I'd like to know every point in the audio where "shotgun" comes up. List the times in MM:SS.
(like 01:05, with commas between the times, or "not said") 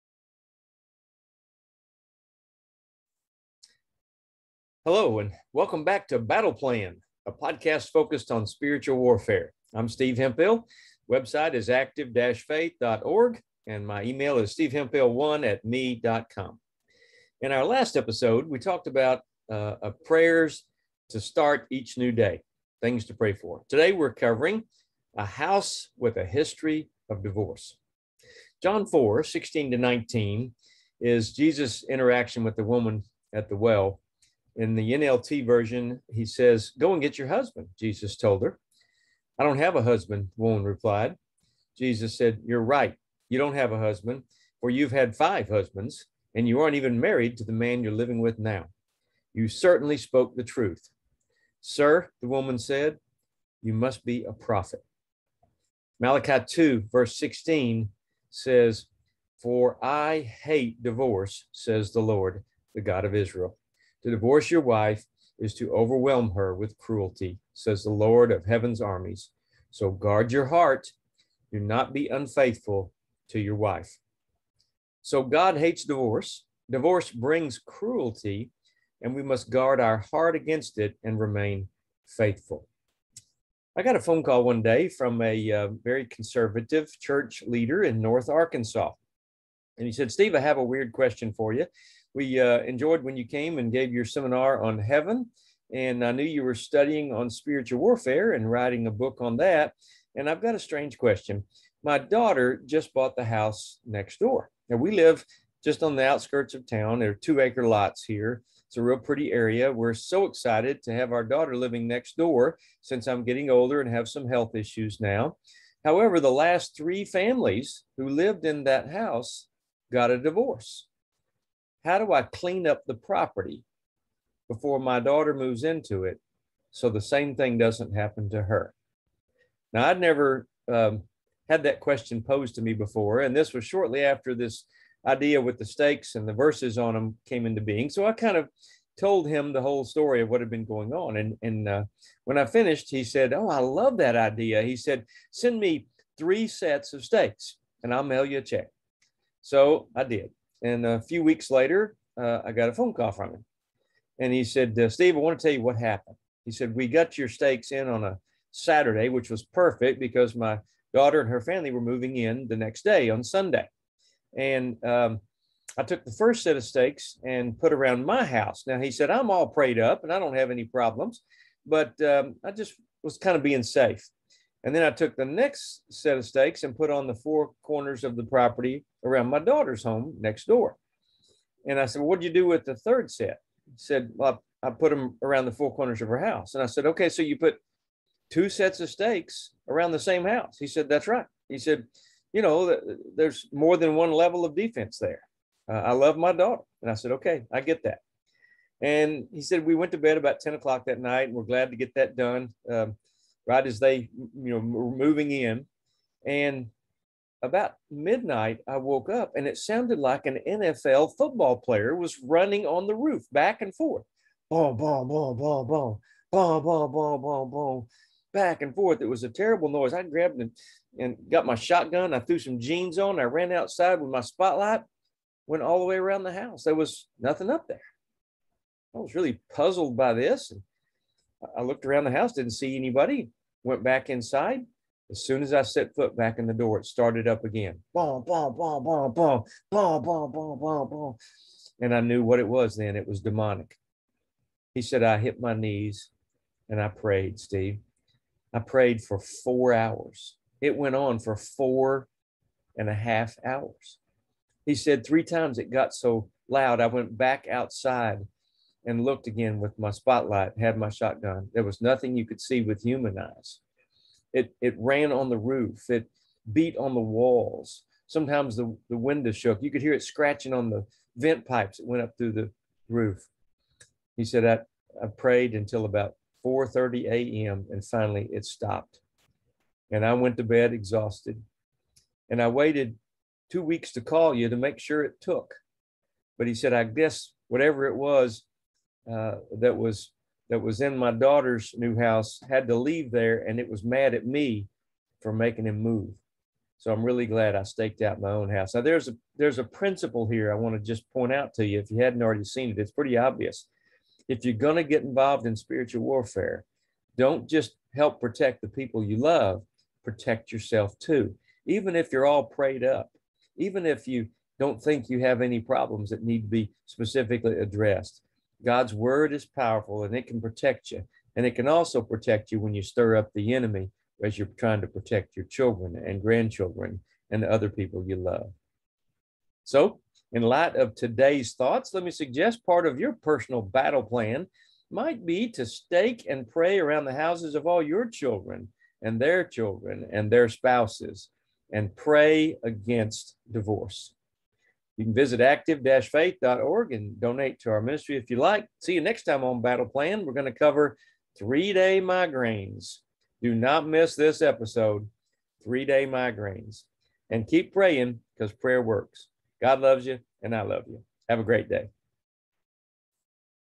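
03:41, 04:20.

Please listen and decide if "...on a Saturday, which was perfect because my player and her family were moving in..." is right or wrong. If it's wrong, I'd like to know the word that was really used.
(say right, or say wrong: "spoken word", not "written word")
wrong: "daughter", not "player".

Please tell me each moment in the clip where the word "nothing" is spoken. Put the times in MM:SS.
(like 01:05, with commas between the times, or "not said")
03:47, 04:21.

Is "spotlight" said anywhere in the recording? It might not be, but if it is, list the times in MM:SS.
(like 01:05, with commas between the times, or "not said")
03:44, 04:19.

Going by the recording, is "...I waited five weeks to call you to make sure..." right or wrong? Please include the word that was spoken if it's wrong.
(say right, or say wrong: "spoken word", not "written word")
wrong: "two", not "five".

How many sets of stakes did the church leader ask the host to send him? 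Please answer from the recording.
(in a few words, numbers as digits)
3.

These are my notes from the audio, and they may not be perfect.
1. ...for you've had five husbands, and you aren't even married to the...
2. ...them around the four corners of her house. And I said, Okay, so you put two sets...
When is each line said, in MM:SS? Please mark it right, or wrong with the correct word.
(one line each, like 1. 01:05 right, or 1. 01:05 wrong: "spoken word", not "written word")
1. 00:44 right
2. 03:04 right.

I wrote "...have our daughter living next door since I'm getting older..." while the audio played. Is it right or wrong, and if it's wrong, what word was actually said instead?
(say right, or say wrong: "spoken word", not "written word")
right.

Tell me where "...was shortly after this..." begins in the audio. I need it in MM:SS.
02:13.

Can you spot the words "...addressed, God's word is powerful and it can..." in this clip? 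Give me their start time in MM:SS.
05:17.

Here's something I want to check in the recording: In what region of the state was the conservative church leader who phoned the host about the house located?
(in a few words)
North Arkansas.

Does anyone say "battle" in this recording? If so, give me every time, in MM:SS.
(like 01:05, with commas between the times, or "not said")
00:06, 05:33, 05:49.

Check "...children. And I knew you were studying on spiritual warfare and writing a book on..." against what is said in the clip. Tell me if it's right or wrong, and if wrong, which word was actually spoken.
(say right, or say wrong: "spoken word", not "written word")
wrong: "heaven", not "children".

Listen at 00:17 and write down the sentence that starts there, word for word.
In our last episode, we talked about uh, uh, prayers to start each new day, things to pray for.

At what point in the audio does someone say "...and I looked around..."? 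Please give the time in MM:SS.
03:50.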